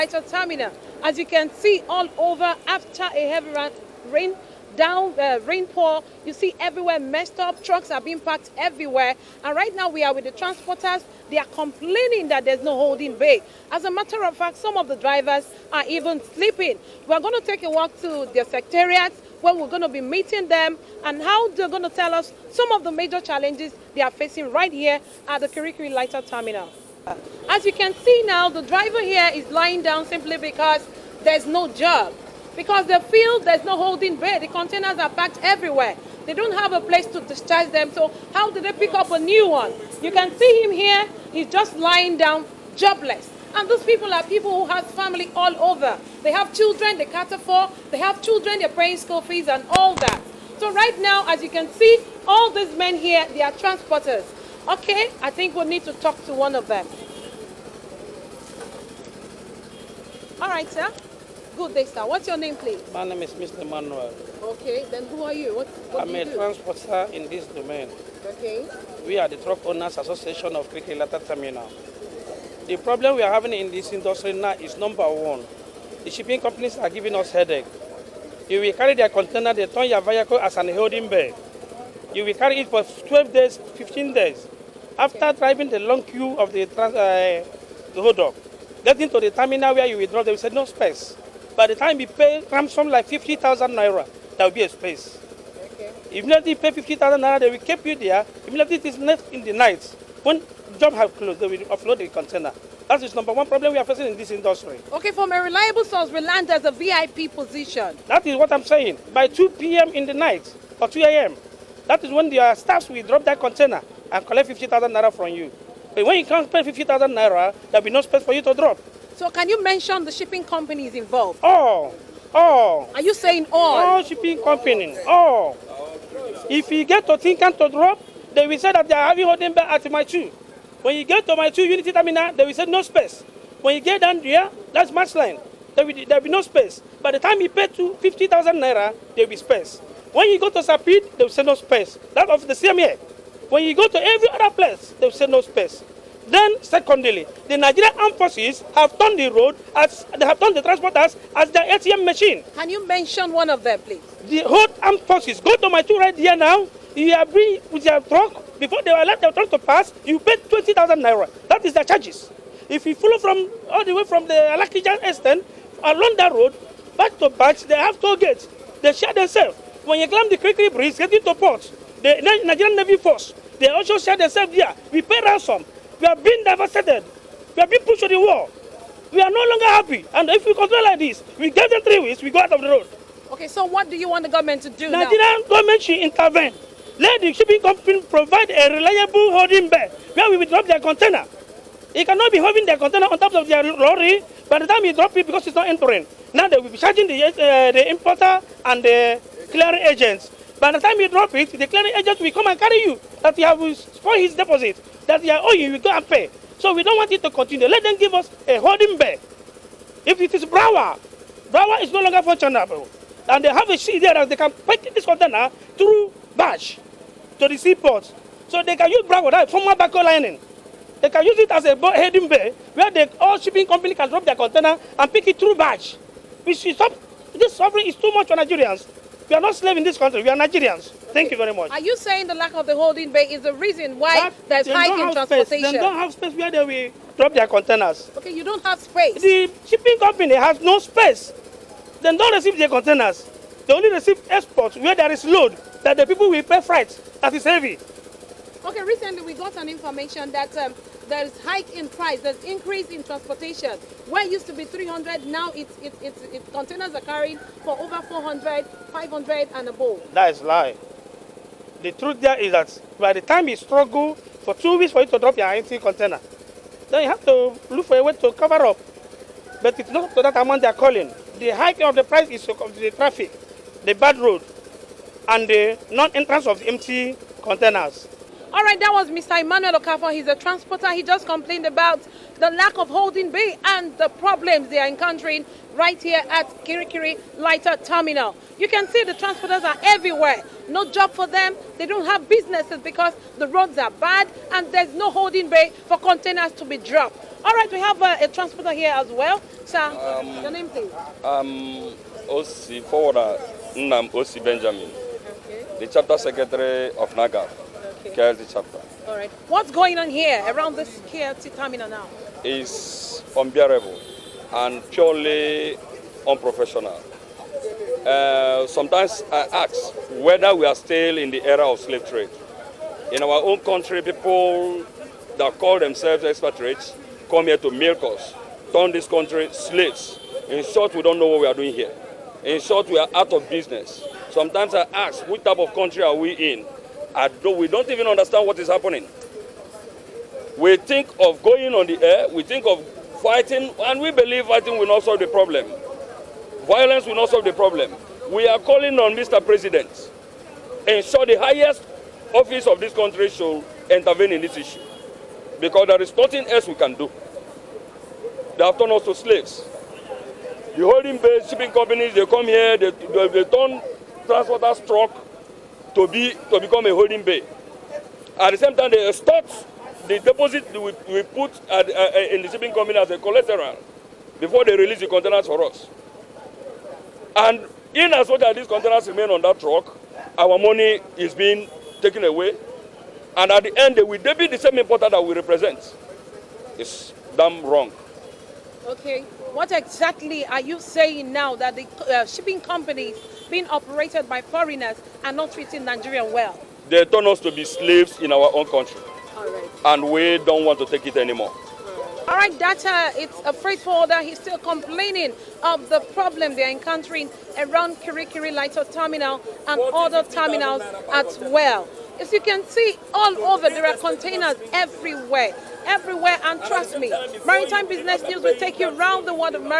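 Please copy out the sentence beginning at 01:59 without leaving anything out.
So can you mention the shipping companies involved?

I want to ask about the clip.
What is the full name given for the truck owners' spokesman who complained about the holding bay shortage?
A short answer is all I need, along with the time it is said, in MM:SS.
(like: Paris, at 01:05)
Emmanuel Okafor, at 04:39.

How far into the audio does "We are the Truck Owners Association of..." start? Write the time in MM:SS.
01:09.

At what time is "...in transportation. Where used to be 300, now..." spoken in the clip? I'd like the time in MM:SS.
04:12.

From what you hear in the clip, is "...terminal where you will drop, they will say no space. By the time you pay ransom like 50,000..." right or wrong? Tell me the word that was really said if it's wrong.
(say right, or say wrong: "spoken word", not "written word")
right.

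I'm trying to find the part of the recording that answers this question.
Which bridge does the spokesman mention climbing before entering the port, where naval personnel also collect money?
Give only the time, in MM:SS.
02:50.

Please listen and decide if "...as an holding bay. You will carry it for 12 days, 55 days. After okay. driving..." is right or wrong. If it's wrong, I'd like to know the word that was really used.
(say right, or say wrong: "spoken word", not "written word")
wrong: "15", not "55".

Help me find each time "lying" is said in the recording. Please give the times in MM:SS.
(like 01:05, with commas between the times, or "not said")
00:29, 00:41.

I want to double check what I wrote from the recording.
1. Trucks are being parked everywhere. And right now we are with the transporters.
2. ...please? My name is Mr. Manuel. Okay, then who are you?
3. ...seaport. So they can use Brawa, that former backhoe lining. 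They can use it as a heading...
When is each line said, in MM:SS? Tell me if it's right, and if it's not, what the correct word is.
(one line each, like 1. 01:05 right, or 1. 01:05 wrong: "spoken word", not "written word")
1. 00:07 right
2. 01:02 right
3. 03:37 right.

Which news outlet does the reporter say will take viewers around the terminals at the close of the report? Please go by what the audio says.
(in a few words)
Maritime Business News.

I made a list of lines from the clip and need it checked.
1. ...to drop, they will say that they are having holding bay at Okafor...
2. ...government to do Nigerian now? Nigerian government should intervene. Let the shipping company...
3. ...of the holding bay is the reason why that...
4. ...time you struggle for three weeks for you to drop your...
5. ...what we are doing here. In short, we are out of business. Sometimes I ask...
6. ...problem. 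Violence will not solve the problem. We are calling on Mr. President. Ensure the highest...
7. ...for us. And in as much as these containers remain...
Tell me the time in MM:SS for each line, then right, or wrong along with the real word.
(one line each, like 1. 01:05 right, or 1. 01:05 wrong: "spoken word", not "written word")
1. 02:07 wrong: "Mile", not "Okafor"
2. 03:04 right
3. 03:52 right
4. 04:23 wrong: "two", not "three"
5. 05:31 right
6. 05:45 right
7. 06:15 right.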